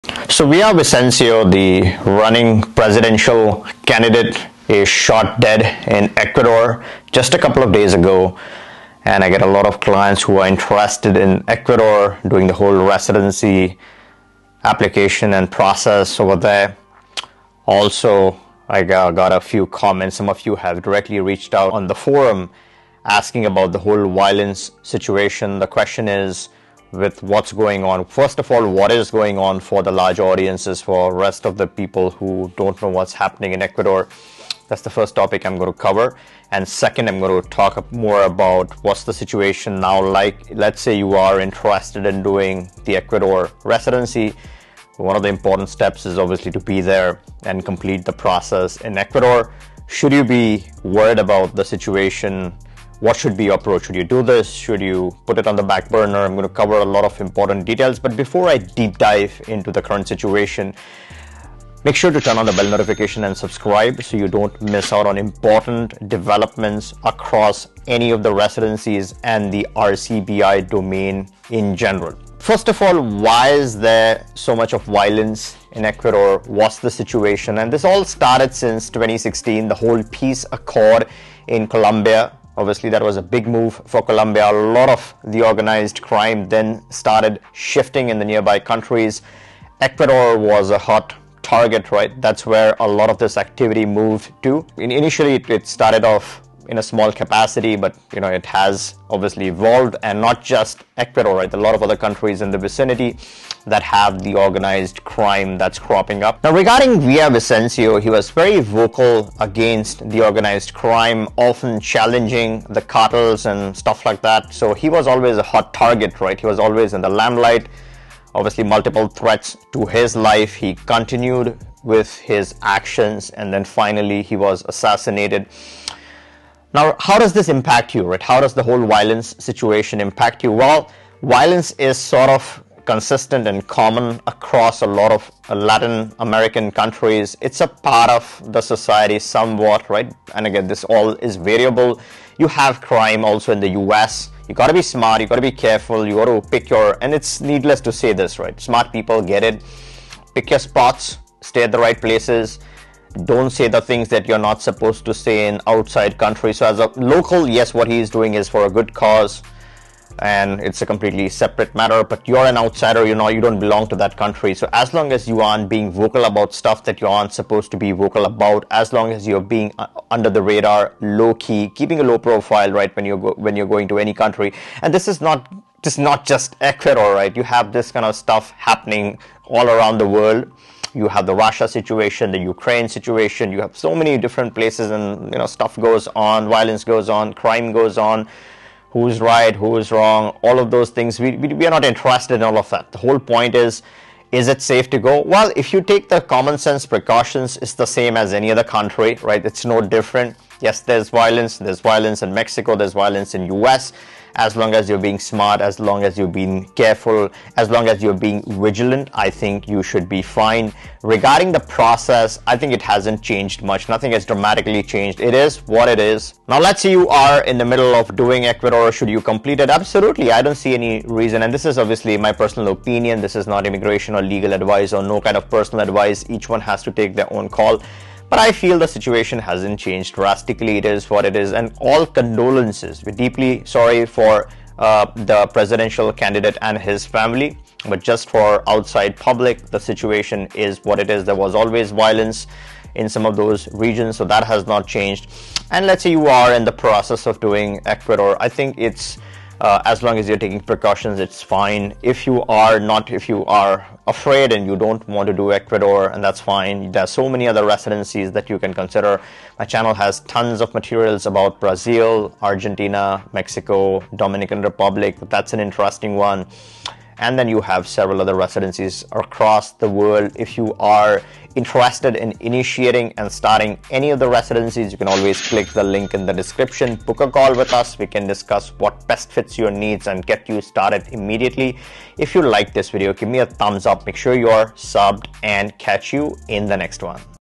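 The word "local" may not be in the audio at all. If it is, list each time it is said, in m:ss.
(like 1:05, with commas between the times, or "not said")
2:36.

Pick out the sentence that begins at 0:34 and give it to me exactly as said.
That's the first topic I'm going to cover.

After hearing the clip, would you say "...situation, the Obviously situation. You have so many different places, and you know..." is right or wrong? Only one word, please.
wrong.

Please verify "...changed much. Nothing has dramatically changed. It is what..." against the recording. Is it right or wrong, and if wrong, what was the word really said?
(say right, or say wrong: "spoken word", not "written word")
right.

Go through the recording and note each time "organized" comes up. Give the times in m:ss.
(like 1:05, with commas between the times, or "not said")
1:25, 1:44, 1:50.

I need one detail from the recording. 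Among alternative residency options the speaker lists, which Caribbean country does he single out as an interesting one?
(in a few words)
Dominican Republic.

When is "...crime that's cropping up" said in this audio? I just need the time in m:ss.
1:45.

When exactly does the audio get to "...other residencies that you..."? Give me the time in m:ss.
4:17.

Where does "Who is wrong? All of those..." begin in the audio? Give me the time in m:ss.
3:09.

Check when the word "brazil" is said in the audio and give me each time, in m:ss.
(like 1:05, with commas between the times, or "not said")
4:21.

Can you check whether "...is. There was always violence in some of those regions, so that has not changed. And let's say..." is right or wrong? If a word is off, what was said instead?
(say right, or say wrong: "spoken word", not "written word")
right.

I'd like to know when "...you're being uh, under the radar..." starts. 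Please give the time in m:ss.
2:49.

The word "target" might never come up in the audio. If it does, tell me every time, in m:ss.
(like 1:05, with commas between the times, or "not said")
1:31, 1:55.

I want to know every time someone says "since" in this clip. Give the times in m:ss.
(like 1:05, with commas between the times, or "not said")
1:18.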